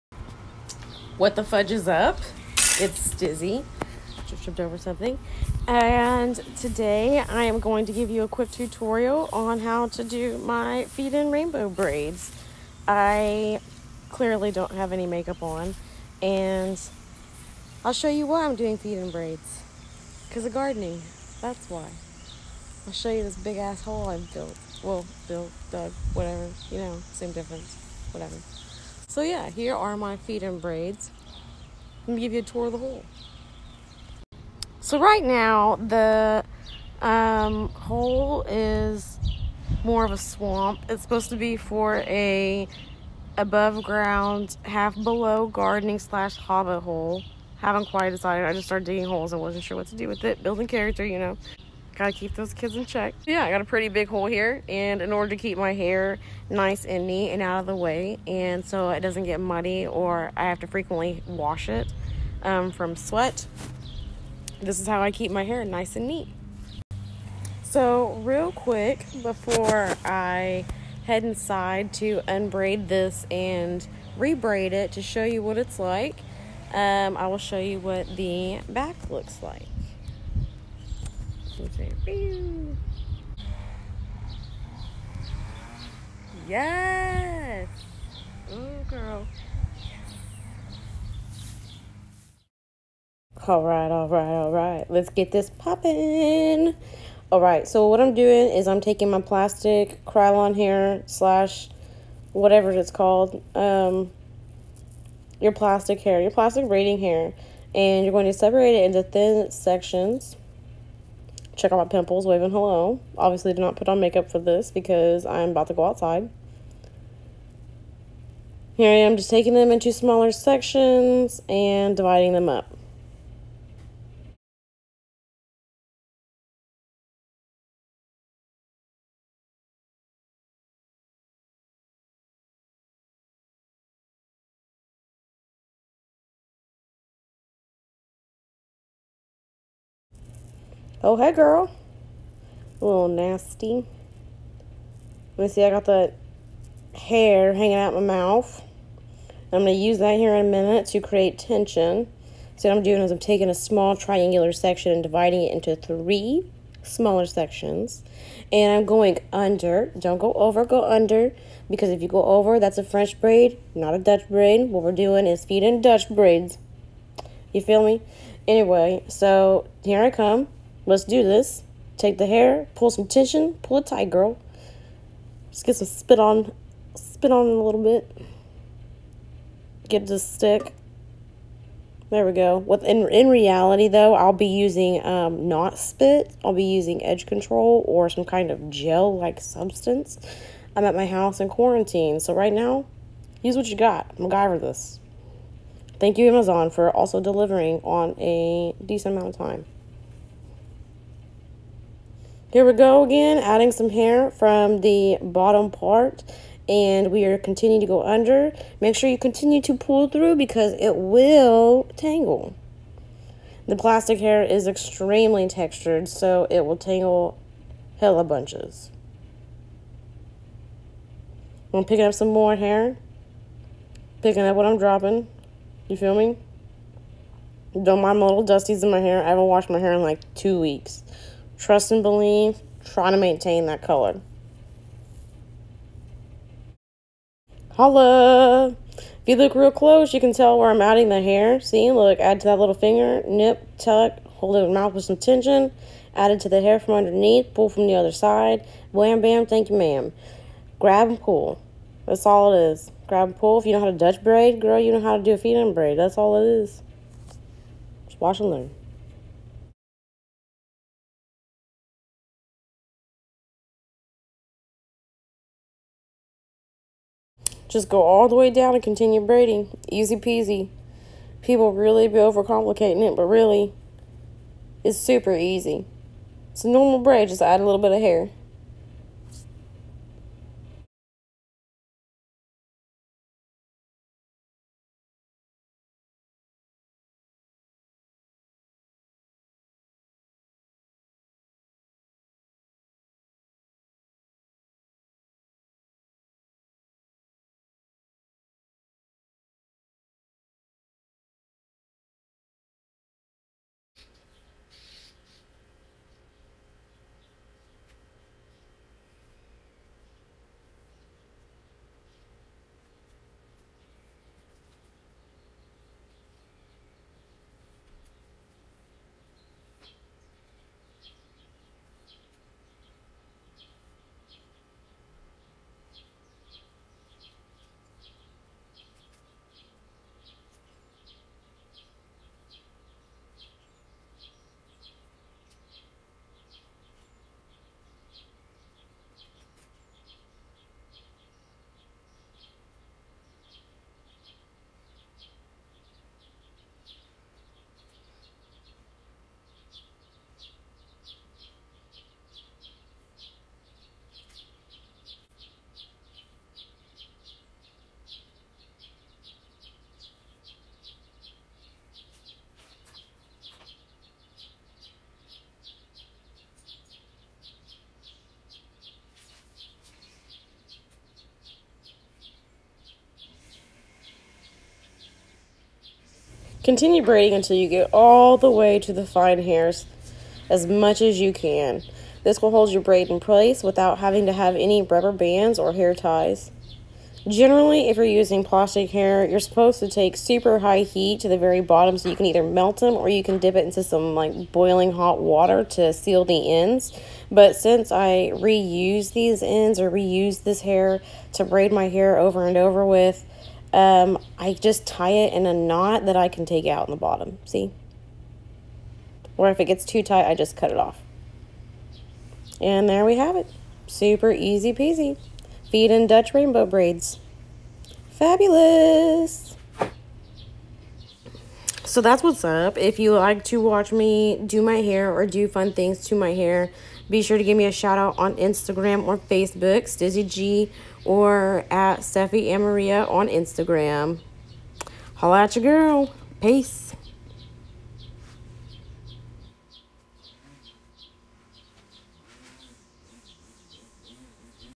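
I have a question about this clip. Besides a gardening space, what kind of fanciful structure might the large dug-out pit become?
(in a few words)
Hobbit hole.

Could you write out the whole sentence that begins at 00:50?
Building character, you know gotta keep those kids in check.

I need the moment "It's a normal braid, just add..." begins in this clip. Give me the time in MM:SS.
04:36.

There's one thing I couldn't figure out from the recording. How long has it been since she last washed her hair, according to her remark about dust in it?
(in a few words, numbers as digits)
2 weeks.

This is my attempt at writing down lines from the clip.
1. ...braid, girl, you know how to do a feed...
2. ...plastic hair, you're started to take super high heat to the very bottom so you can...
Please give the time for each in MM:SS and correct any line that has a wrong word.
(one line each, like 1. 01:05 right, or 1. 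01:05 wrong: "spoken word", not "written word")
1. 04:14 right
2. 06:28 wrong: "supposed", not "started".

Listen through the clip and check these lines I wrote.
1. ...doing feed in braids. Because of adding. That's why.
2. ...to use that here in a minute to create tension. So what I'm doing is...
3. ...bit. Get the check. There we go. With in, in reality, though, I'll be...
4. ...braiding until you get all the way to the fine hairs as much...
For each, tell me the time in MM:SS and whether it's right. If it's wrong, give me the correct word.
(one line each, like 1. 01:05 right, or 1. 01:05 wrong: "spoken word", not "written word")
1. 00:18 wrong: "gardening", not "adding"
2. 02:29 right
3. 02:57 wrong: "stick", not "check"
4. 06:17 right.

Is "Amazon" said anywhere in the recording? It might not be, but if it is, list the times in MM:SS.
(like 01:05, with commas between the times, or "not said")
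03:16.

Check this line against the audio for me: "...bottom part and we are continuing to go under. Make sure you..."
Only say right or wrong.
right.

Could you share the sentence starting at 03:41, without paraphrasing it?
I'm picking up some more hair, picking up what I'm dropping.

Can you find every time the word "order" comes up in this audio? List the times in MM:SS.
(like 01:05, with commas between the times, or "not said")
00:55.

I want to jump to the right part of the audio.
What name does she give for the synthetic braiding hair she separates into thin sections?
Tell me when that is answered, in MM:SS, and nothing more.
01:40.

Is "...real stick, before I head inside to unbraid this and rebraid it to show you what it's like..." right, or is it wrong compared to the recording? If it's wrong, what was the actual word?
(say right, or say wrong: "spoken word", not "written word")
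wrong: "quick", not "stick".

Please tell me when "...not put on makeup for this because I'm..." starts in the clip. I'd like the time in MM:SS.
01:53.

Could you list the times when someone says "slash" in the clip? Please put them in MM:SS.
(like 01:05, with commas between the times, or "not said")
00:45, 01:41.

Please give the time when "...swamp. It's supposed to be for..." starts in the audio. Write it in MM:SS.
00:40.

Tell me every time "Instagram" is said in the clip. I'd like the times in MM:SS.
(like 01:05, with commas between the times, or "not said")
07:08, 07:13.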